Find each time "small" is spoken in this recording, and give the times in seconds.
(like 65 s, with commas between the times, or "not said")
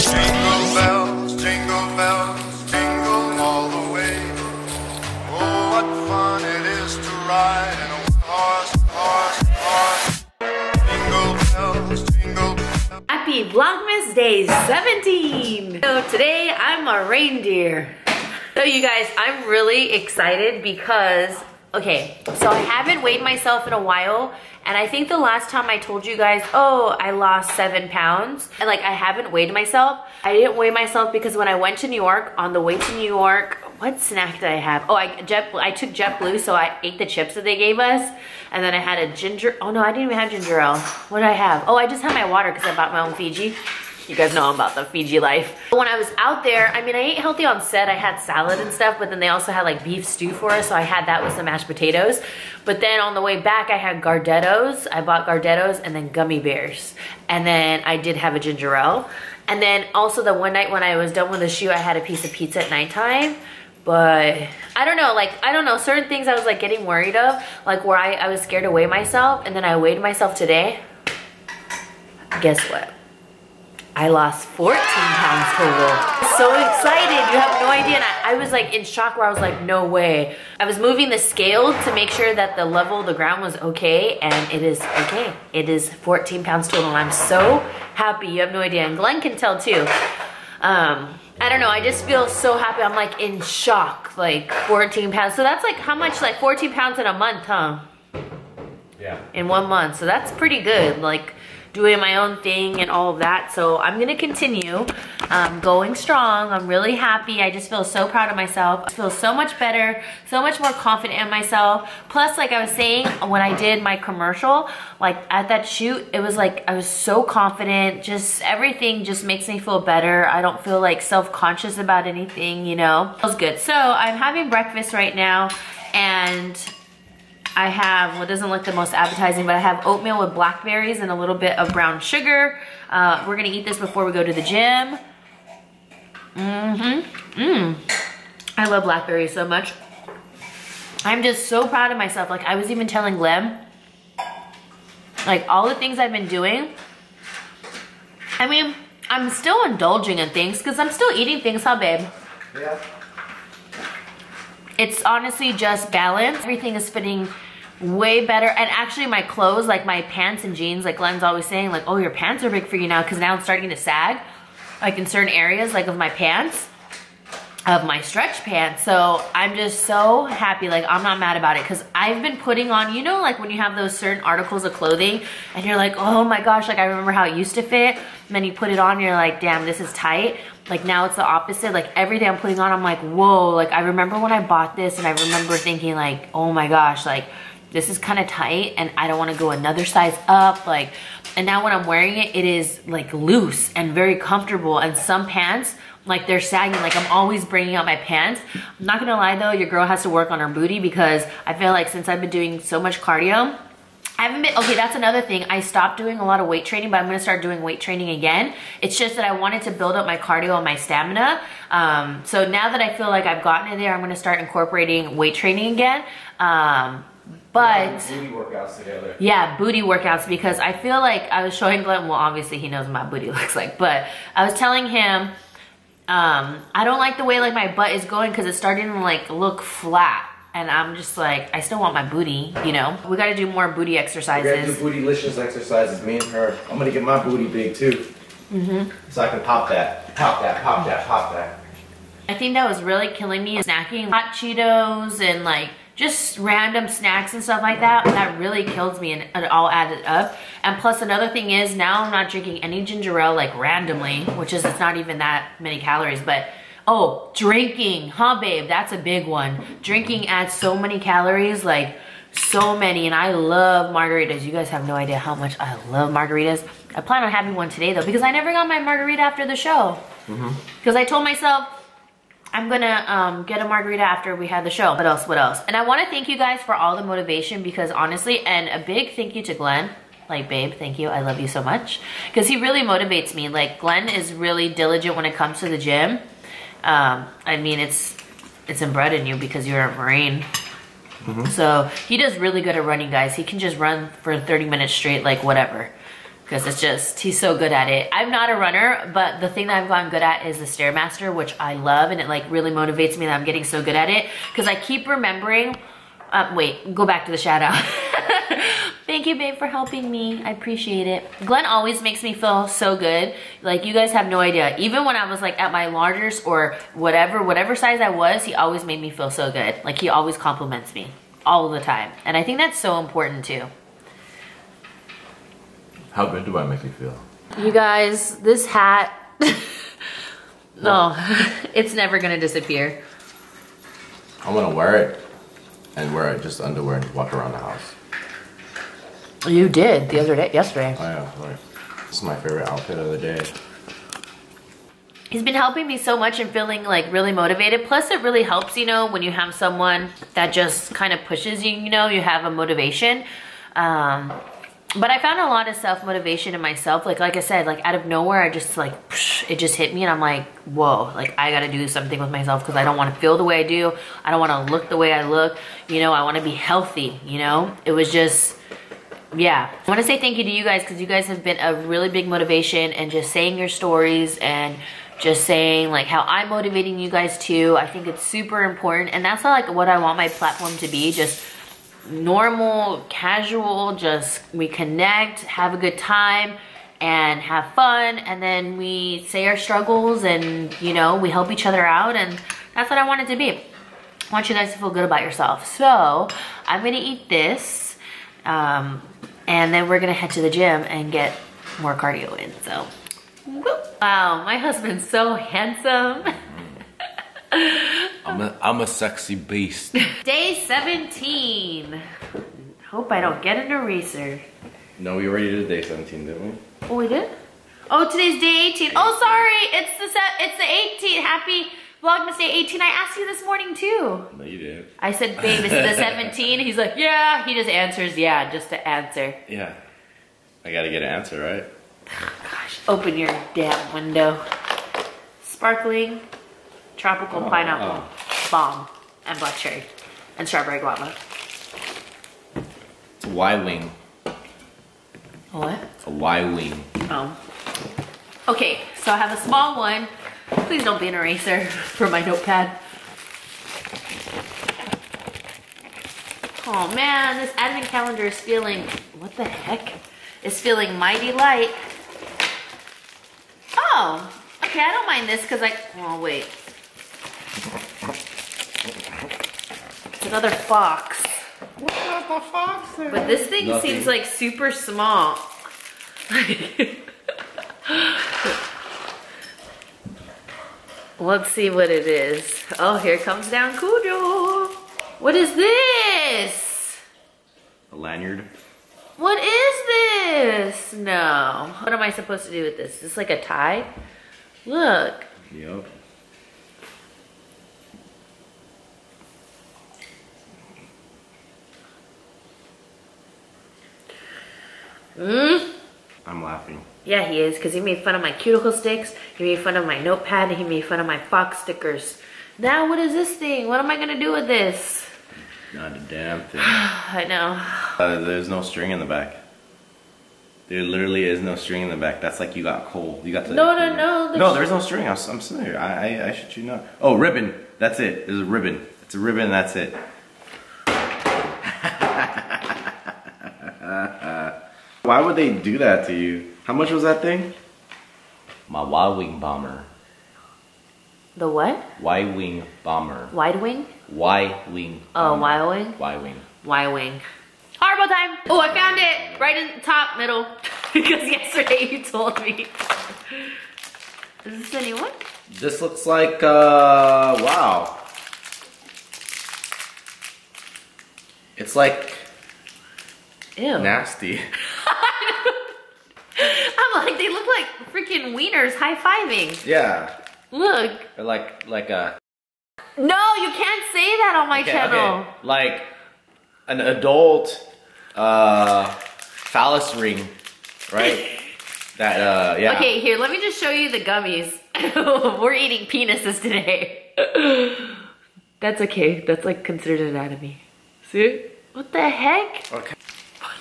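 449 s, 474 s.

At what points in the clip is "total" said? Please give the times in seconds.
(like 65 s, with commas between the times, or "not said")
75 s, 86 s.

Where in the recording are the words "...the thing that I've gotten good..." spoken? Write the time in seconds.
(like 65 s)
299 s.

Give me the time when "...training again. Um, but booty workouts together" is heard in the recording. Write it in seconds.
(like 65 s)
215 s.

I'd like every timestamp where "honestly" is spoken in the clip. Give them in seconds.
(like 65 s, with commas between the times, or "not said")
155 s, 277 s.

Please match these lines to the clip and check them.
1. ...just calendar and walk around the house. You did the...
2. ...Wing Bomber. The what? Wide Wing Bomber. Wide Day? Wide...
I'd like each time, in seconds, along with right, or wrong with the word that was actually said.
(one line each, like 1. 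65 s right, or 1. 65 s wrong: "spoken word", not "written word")
1. 336 s wrong: "underwear", not "calendar"
2. 539 s wrong: "Wing", not "Day".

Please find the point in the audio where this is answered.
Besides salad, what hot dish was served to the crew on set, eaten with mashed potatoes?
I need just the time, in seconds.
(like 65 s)
49 s.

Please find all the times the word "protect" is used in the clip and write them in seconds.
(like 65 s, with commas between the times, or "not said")
not said.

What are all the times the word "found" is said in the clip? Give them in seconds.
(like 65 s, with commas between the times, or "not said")
355 s, 548 s.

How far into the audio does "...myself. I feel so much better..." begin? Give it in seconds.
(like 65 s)
108 s.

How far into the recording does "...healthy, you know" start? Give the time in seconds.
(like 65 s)
366 s.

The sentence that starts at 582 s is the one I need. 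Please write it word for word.
Okay, here, let me just show you the gummies.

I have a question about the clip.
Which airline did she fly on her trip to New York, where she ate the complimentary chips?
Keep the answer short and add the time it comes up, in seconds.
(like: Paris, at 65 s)
JetBlue, at 35 s.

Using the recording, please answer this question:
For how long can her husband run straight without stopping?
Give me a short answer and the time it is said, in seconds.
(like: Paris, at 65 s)
30 minutes, at 294 s.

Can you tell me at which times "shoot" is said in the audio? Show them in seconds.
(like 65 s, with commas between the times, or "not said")
115 s.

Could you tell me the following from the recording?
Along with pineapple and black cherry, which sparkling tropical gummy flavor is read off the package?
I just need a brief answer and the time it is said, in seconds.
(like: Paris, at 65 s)
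strawberry guava, at 440 s.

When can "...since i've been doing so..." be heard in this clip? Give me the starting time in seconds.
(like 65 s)
201 s.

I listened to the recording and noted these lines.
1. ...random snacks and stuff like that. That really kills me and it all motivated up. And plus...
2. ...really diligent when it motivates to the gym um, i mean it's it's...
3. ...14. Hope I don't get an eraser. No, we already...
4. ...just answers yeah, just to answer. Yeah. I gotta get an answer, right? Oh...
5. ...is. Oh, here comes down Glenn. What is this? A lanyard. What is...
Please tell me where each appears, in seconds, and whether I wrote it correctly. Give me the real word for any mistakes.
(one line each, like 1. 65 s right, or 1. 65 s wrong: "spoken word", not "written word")
1. 246 s wrong: "added", not "motivated"
2. 284 s wrong: "comes", not "motivates"
3. 410 s wrong: "17", not "14"
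4. 427 s right
5. 482 s wrong: "Cujo", not "Glenn".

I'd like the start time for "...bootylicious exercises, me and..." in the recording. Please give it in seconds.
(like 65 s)
235 s.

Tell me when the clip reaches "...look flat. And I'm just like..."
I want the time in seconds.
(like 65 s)
229 s.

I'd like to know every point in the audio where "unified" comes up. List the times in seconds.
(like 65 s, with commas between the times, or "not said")
not said.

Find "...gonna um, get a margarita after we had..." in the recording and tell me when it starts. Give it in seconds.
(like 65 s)
272 s.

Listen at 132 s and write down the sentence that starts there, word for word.
Uh, we're gonna eat this before we go to the gym.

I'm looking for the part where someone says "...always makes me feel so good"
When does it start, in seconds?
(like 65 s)
311 s.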